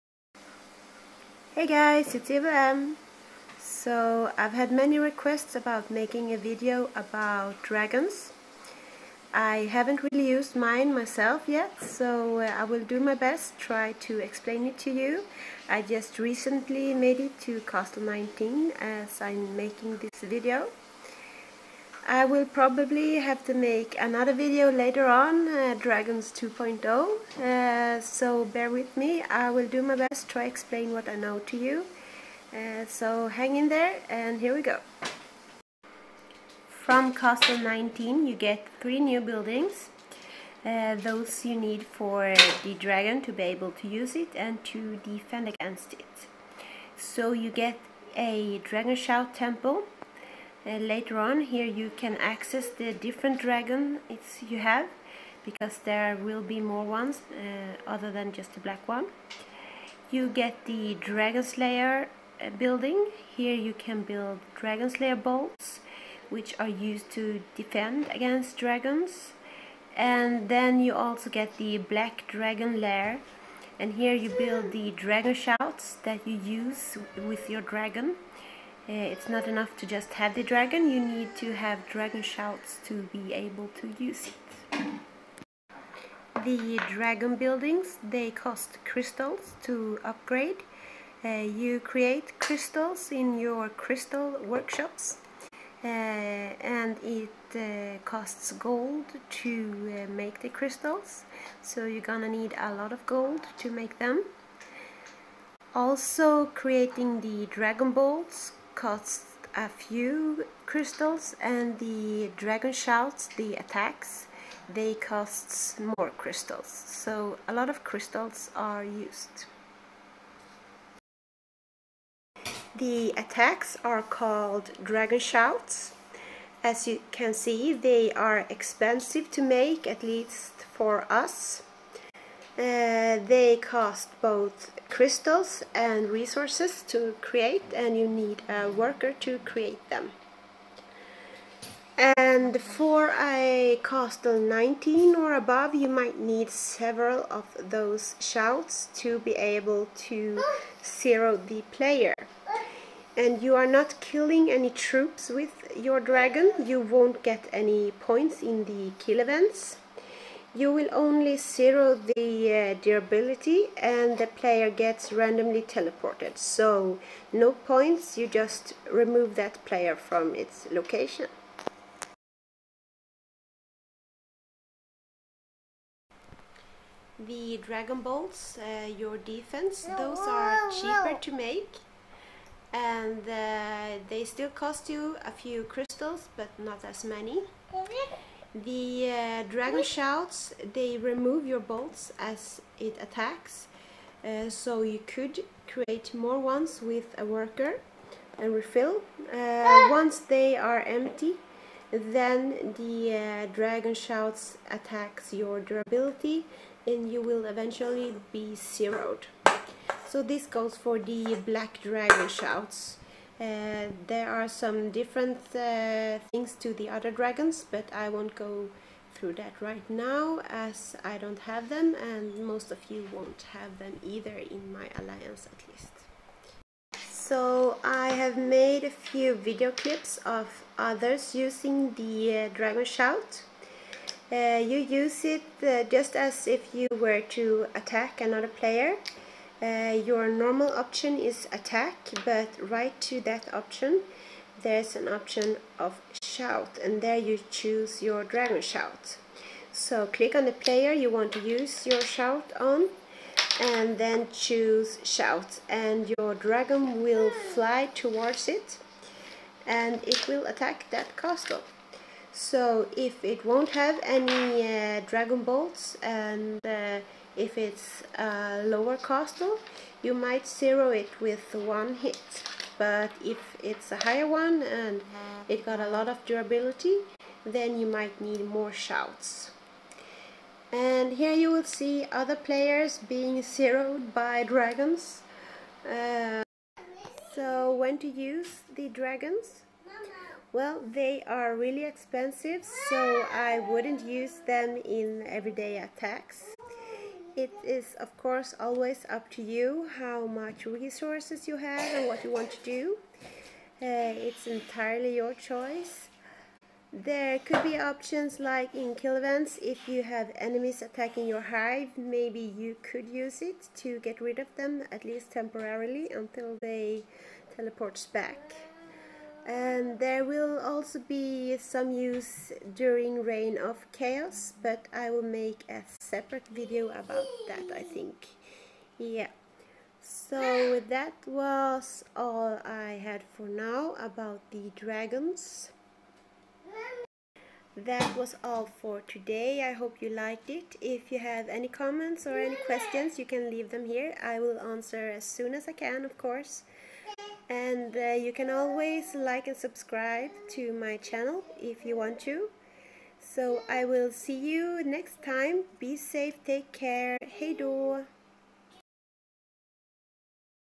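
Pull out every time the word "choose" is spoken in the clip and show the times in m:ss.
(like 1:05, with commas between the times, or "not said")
4:07, 4:14.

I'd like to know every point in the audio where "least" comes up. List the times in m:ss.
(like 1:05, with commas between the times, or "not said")
2:10, 3:45, 5:15.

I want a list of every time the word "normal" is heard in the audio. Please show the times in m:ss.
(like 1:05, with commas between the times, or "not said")
4:00.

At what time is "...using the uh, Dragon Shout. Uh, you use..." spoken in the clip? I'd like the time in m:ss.
3:51.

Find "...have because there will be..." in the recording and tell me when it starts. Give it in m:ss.
0:54.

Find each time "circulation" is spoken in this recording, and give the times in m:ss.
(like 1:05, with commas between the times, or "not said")
not said.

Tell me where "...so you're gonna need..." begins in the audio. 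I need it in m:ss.
1:41.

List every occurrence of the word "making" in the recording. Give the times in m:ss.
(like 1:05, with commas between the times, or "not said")
0:05, 0:19.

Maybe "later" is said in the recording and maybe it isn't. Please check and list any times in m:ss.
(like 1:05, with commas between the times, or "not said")
0:24, 0:50.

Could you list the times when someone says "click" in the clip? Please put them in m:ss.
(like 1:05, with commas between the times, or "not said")
4:10.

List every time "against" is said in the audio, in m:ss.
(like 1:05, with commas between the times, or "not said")
0:45, 1:08.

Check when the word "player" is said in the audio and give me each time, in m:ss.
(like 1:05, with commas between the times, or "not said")
2:31, 2:44, 2:49, 3:58, 4:10, 4:42.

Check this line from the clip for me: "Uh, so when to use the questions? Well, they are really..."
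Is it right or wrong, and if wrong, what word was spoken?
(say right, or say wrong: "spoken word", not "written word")
wrong: "dragons", not "questions".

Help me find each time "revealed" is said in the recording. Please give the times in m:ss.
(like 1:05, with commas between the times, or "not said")
not said.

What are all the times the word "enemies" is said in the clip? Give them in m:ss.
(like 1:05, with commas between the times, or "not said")
5:10.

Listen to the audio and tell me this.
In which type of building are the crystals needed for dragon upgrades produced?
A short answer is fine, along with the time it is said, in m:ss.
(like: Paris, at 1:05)
Crystal workshops, at 1:33.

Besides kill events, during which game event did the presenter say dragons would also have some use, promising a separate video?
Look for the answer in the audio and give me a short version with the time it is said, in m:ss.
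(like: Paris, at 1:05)
Reign of Chaos, at 5:23.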